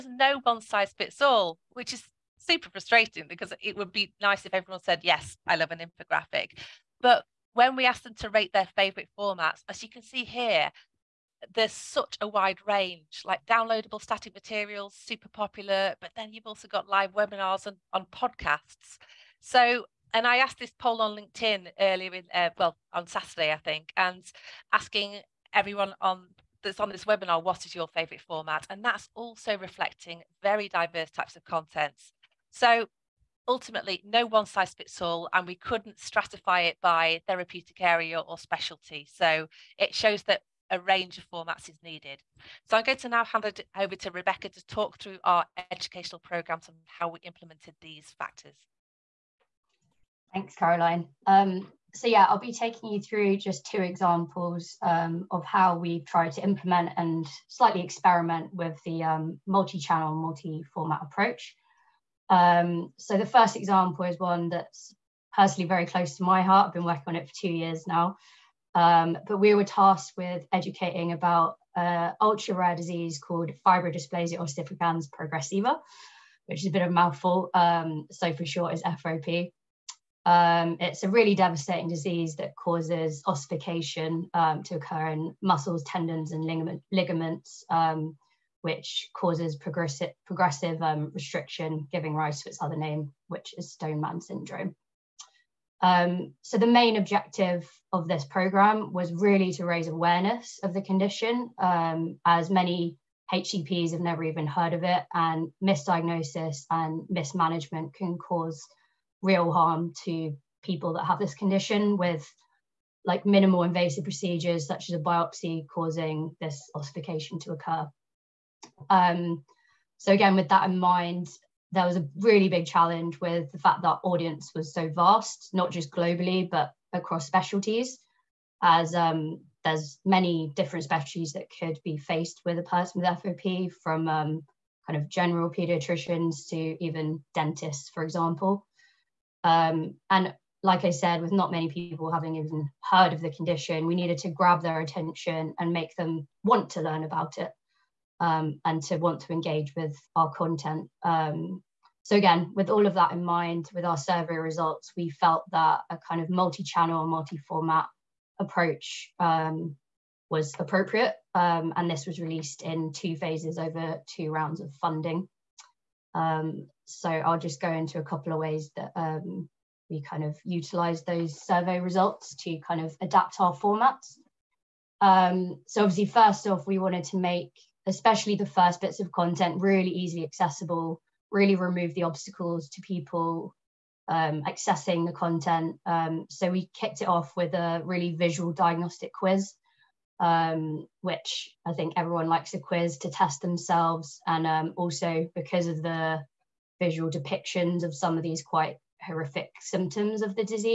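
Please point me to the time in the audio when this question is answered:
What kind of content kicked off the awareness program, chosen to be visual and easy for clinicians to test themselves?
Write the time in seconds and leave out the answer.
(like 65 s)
188 s.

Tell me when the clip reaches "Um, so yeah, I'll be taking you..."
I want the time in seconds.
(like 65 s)
51 s.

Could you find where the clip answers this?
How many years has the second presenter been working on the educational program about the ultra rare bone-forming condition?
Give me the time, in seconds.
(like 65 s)
67 s.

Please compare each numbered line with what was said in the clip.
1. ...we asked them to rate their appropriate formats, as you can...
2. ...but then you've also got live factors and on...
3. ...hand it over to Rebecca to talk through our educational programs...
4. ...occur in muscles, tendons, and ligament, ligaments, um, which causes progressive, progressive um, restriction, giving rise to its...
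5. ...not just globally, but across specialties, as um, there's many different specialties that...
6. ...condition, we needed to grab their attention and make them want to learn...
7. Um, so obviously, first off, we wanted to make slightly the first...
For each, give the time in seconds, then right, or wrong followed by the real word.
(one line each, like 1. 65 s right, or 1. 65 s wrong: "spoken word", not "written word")
1. 7 s wrong: "favorite", not "appropriate"
2. 15 s wrong: "webinars", not "factors"
3. 43 s right
4. 84 s right
5. 125 s right
6. 143 s right
7. 174 s wrong: "especially", not "slightly".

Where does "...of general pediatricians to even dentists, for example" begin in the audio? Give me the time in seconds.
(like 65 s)
135 s.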